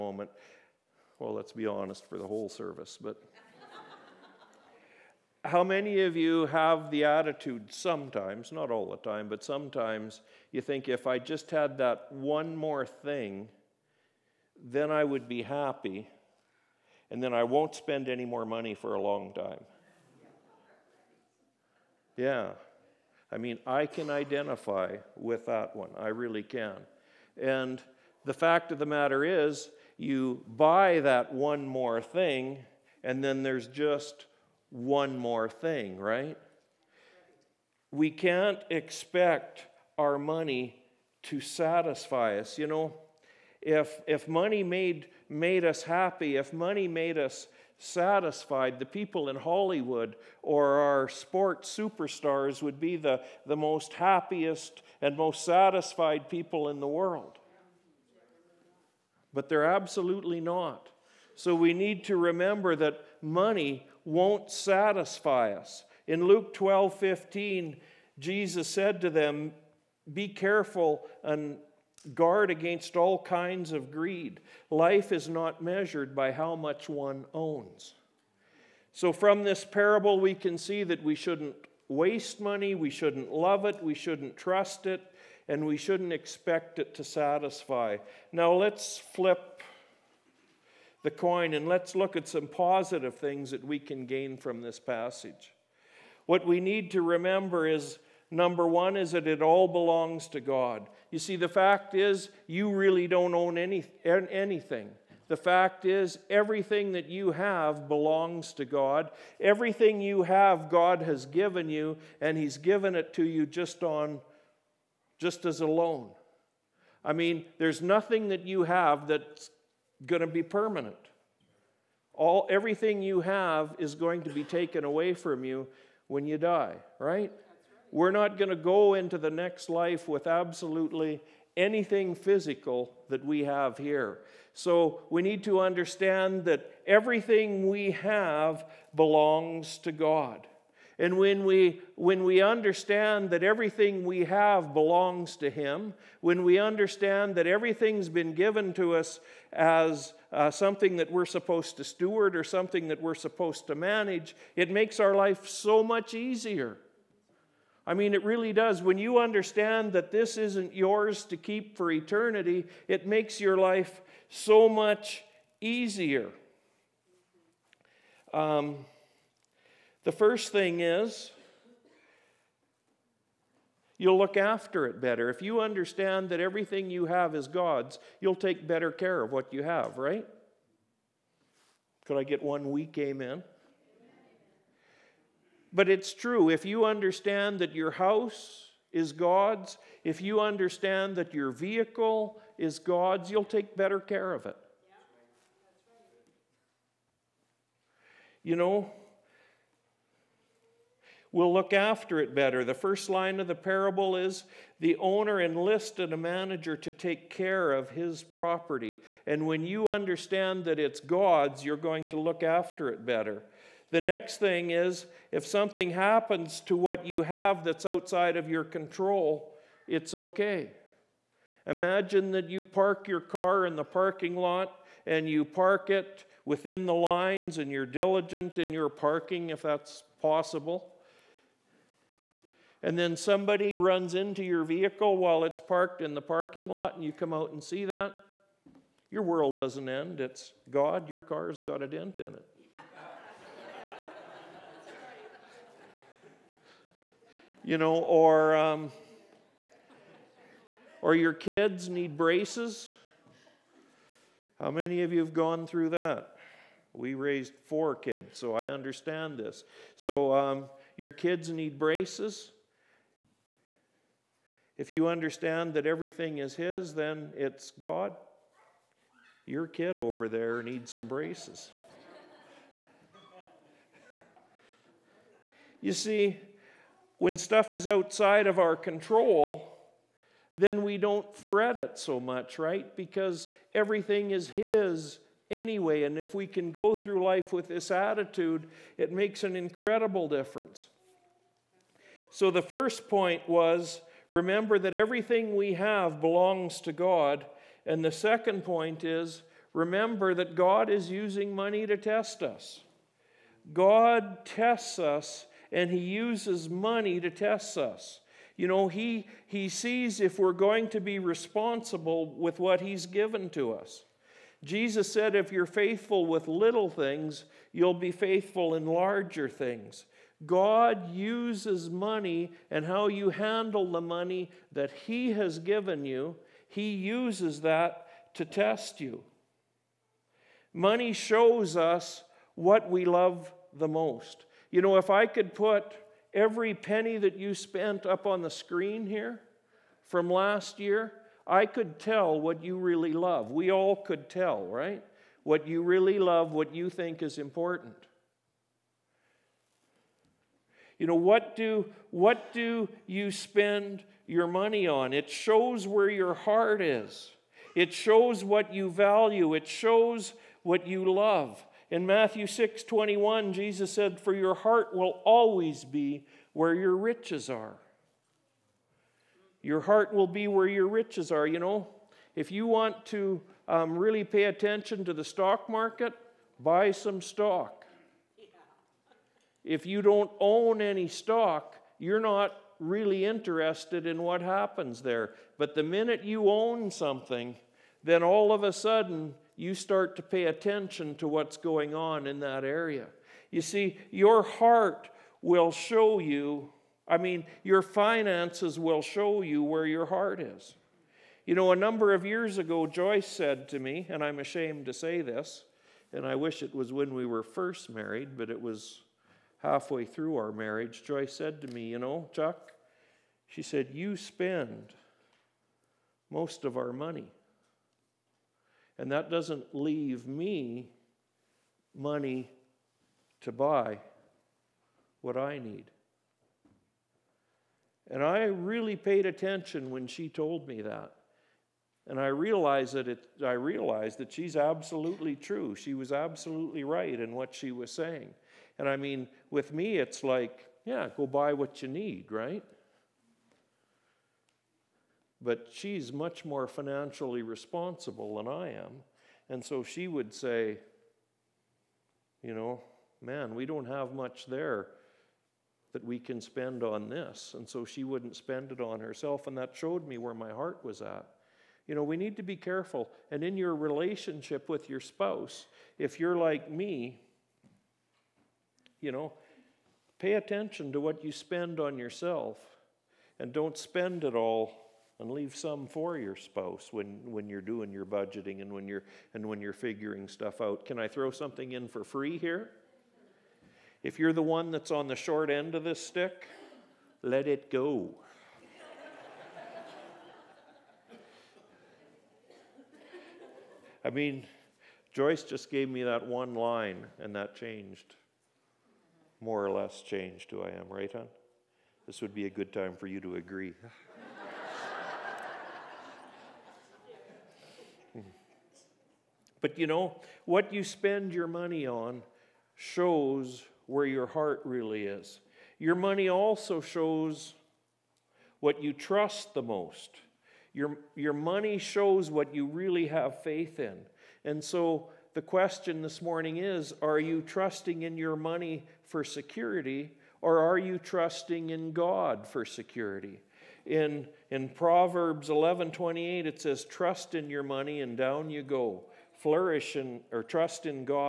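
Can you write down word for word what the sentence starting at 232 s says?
And then somebody runs into your vehicle while it's parked in the parking lot and you come out and see that.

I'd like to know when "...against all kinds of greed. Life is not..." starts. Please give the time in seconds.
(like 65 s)
72 s.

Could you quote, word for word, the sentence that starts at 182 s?
Could I get one weak amen?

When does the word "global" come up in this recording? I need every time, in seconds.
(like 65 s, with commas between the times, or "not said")
not said.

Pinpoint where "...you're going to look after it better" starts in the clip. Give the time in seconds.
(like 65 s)
211 s.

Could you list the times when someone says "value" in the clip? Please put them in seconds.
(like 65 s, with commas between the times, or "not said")
358 s.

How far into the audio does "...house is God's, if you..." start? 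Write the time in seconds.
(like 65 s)
187 s.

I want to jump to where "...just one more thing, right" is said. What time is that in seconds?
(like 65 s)
33 s.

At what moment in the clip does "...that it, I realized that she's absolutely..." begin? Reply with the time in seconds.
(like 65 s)
432 s.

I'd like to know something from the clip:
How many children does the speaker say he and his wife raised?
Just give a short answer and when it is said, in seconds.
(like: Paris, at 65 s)
4, at 257 s.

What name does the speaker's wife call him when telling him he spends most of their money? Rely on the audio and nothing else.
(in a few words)
Chuck.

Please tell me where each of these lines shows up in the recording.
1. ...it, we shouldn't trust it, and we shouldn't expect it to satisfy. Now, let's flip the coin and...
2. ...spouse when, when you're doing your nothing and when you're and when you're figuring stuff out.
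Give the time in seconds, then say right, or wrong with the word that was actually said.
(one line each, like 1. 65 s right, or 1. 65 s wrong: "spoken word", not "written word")
1. 83 s right
2. 476 s wrong: "budgeting", not "nothing".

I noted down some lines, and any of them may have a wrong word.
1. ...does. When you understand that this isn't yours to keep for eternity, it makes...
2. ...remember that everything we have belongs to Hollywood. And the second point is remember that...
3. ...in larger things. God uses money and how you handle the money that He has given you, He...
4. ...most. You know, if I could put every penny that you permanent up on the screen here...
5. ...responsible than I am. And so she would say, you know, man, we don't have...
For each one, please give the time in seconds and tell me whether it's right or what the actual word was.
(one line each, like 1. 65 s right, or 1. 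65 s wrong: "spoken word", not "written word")
1. 158 s right
2. 294 s wrong: "God", not "Hollywood"
3. 318 s right
4. 333 s wrong: "spent", not "permanent"
5. 447 s right.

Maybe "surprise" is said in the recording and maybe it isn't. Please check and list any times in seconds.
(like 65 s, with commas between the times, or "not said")
not said.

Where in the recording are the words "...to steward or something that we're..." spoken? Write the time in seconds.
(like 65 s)
151 s.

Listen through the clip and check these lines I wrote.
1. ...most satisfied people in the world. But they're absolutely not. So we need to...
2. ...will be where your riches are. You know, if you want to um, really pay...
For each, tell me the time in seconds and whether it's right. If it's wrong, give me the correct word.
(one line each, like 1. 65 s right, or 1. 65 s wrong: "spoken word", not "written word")
1. 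55 s right
2. 370 s right.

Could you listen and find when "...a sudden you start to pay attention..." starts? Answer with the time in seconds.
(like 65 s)
388 s.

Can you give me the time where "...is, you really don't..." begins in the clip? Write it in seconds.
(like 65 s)
101 s.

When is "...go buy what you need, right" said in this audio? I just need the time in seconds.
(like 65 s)
441 s.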